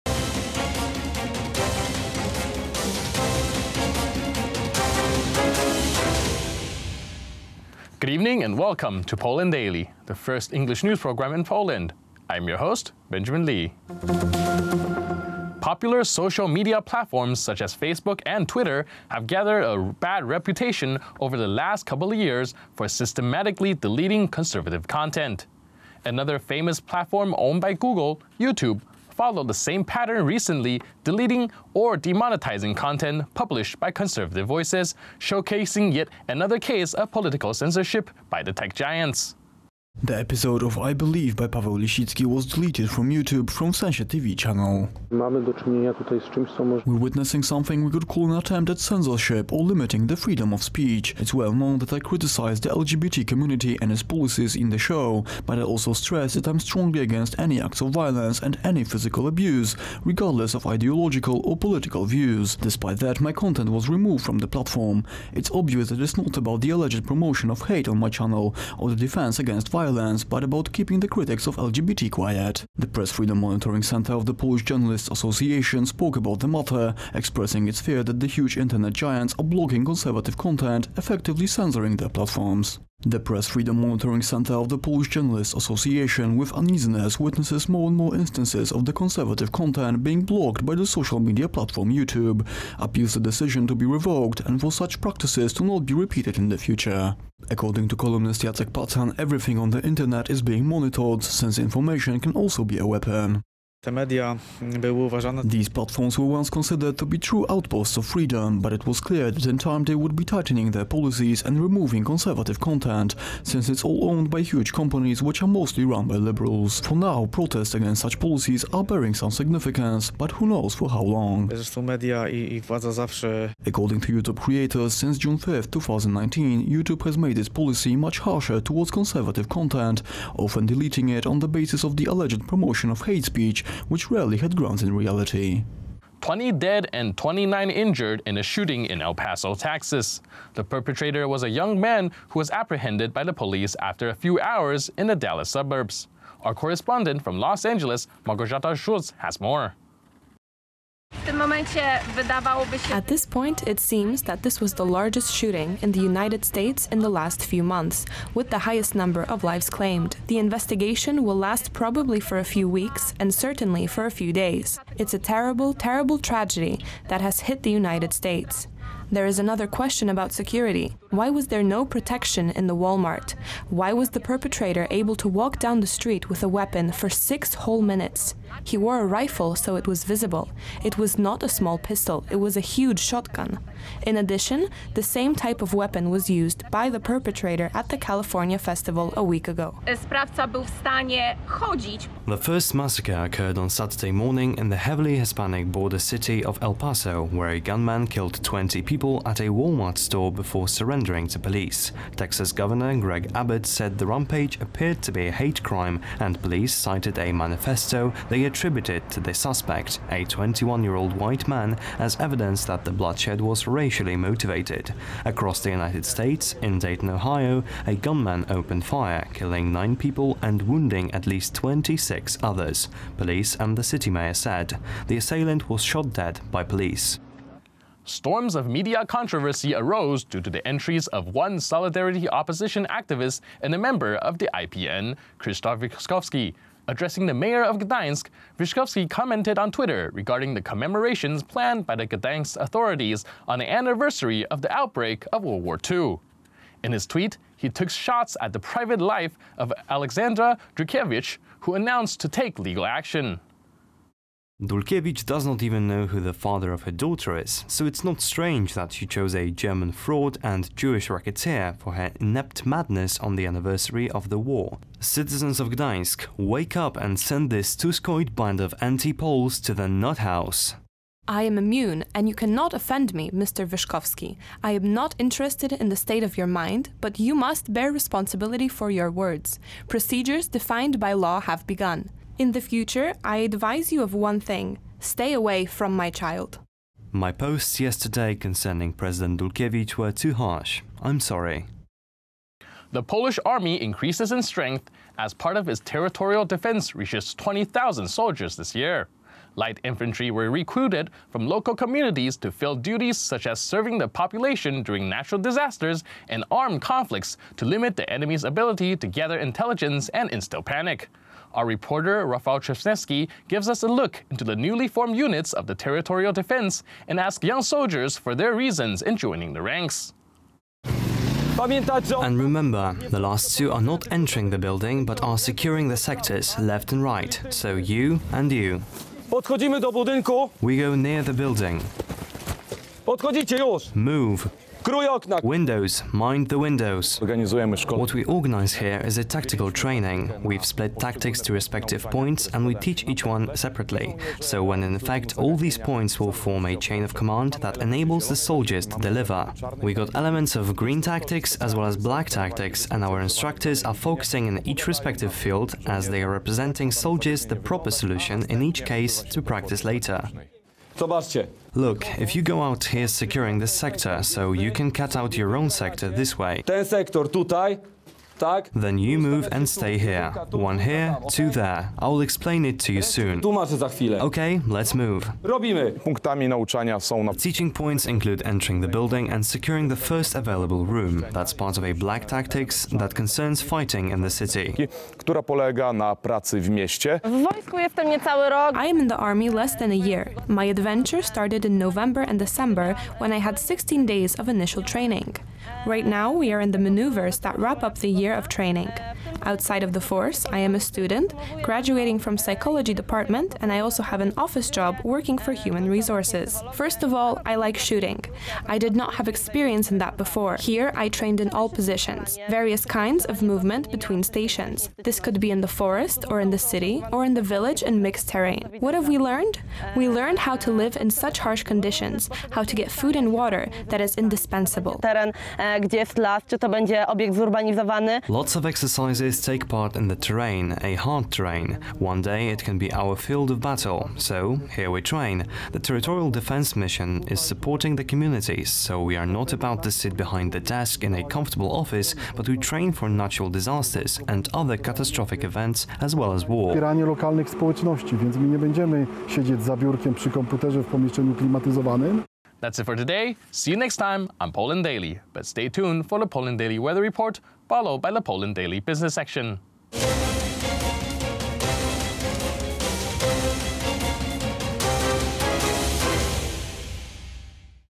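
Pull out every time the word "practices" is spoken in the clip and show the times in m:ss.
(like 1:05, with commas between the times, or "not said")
1:35, 5:59.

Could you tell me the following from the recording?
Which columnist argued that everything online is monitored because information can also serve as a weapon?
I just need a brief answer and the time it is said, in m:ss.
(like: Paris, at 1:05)
Jacek Patan, at 1:38.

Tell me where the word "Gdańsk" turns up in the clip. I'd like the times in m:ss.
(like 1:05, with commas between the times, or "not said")
3:57, 4:02, 4:25.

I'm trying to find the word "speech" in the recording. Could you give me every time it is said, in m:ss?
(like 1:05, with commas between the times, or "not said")
0:50, 2:13.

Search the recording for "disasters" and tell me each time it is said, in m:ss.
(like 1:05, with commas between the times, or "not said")
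5:05, 7:23.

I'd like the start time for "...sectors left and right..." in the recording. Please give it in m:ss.
5:25.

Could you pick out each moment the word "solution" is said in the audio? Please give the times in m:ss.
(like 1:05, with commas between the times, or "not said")
5:57.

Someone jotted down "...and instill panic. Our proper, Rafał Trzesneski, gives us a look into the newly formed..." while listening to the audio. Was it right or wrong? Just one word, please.
wrong.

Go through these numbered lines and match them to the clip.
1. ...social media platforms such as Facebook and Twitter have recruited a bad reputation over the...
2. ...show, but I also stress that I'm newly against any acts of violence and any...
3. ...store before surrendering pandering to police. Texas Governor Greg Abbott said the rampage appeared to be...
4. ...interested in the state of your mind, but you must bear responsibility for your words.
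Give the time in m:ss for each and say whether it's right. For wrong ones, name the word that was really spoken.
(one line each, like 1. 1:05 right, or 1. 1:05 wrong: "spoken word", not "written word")
1. 0:16 wrong: "gathered", not "recruited"
2. 0:54 wrong: "strongly", not "newly"
3. 3:19 right
4. 4:35 right.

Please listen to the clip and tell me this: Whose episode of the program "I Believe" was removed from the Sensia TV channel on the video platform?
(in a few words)
Paweł Lisicki.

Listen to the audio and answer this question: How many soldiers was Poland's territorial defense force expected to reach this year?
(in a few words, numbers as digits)
20,000.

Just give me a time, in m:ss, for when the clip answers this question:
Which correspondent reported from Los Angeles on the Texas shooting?
2:28.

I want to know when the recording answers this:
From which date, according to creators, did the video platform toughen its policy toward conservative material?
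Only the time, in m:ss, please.
2:05.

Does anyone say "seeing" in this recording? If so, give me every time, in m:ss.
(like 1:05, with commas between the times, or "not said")
not said.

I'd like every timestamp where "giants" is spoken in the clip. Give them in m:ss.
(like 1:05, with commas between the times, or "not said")
0:38, 1:18.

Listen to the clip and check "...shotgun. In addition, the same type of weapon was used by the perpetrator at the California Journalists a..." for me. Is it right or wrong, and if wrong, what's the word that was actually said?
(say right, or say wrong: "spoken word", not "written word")
wrong: "Festival", not "Journalists".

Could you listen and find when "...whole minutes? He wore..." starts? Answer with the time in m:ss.
2:57.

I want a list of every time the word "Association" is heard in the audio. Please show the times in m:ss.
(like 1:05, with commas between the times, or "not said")
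1:15, 1:25.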